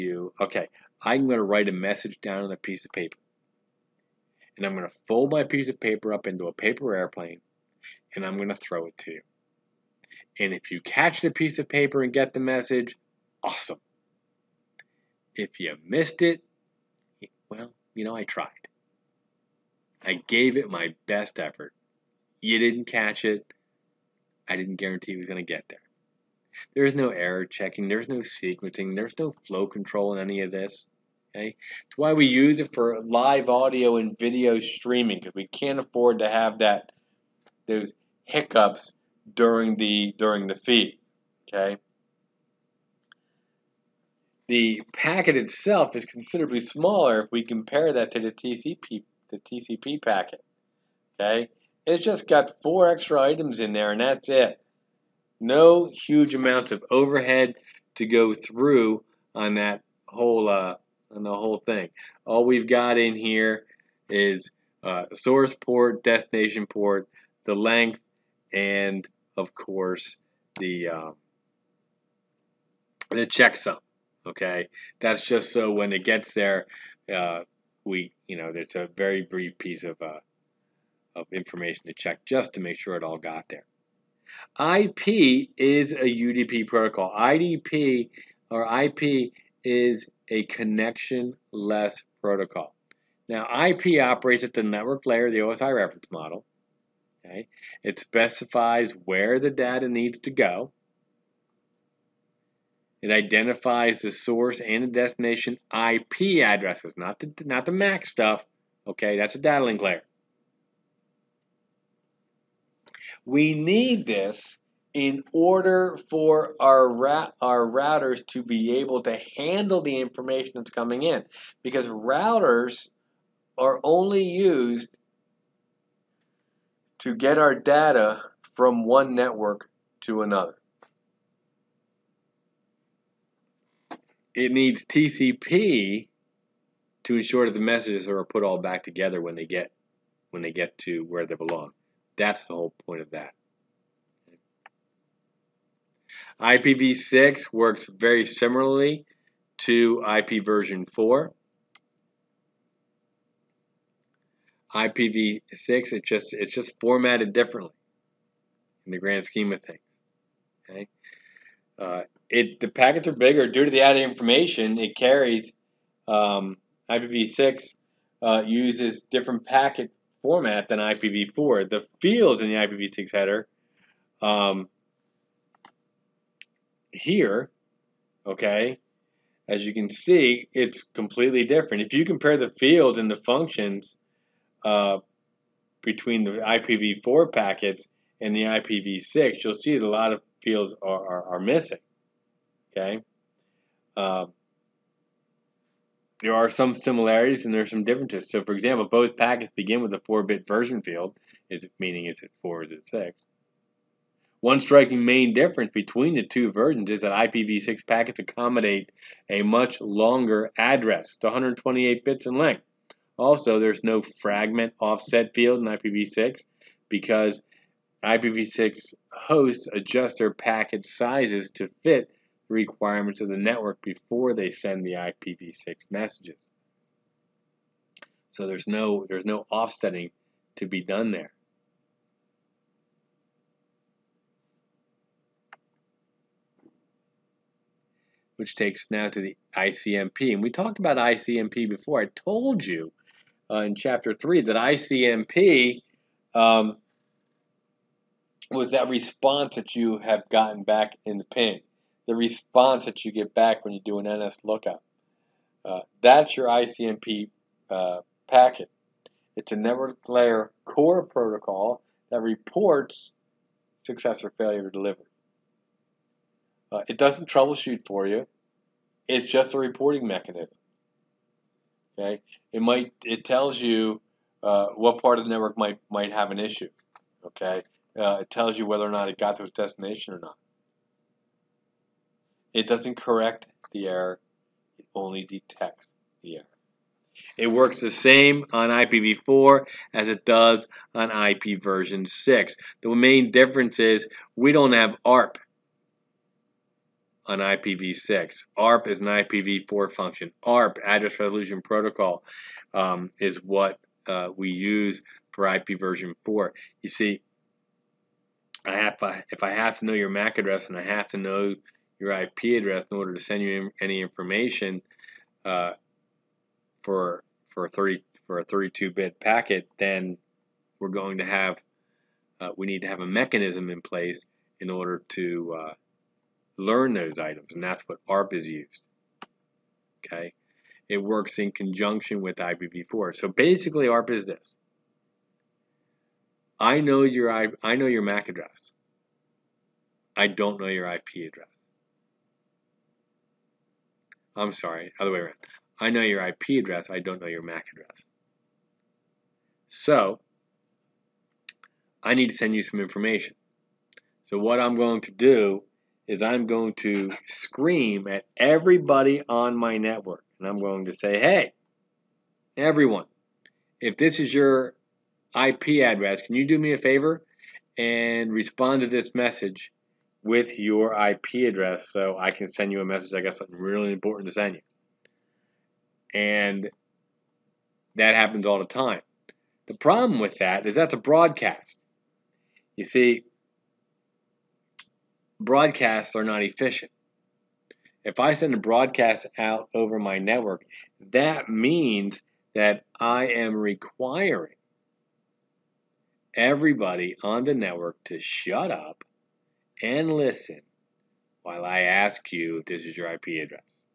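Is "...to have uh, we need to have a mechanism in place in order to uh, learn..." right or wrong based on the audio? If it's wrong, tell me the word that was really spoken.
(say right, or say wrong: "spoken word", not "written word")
right.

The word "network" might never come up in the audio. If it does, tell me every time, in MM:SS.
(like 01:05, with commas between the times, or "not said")
01:34, 02:09, 03:43, 04:19, 04:35, 05:59, 06:30, 06:37.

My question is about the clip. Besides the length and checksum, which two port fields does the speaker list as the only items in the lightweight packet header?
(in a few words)
source port, destination port.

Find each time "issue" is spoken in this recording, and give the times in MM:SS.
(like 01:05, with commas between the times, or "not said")
04:36.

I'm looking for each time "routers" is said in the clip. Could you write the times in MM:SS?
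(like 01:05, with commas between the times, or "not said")
01:57, 02:01.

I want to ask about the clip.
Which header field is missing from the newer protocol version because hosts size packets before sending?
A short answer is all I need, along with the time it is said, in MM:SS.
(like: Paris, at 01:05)
fragment offset field, at 03:34.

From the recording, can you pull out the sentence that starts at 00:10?
And if you catch the piece of paper and get the message, awesome.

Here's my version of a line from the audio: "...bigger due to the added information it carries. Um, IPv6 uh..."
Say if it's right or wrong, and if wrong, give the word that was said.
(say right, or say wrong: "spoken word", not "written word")
right.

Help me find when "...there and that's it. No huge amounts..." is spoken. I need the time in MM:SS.
00:53.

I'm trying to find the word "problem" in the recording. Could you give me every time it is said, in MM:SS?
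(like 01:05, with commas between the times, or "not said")
06:19.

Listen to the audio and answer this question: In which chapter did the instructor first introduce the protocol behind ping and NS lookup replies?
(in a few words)
chapter 3.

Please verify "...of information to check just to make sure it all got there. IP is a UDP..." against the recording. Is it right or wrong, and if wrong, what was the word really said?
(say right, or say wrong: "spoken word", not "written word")
right.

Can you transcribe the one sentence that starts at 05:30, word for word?
Okay, it works in conjunction with IPv4.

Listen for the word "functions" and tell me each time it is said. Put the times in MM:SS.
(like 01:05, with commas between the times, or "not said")
03:03, 04:59.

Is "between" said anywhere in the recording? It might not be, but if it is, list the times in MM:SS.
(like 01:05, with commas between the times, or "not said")
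03:05, 03:25.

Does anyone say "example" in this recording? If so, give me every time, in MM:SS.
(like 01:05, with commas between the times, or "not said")
03:18.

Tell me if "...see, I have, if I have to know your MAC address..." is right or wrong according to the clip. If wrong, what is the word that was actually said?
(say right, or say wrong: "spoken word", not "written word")
right.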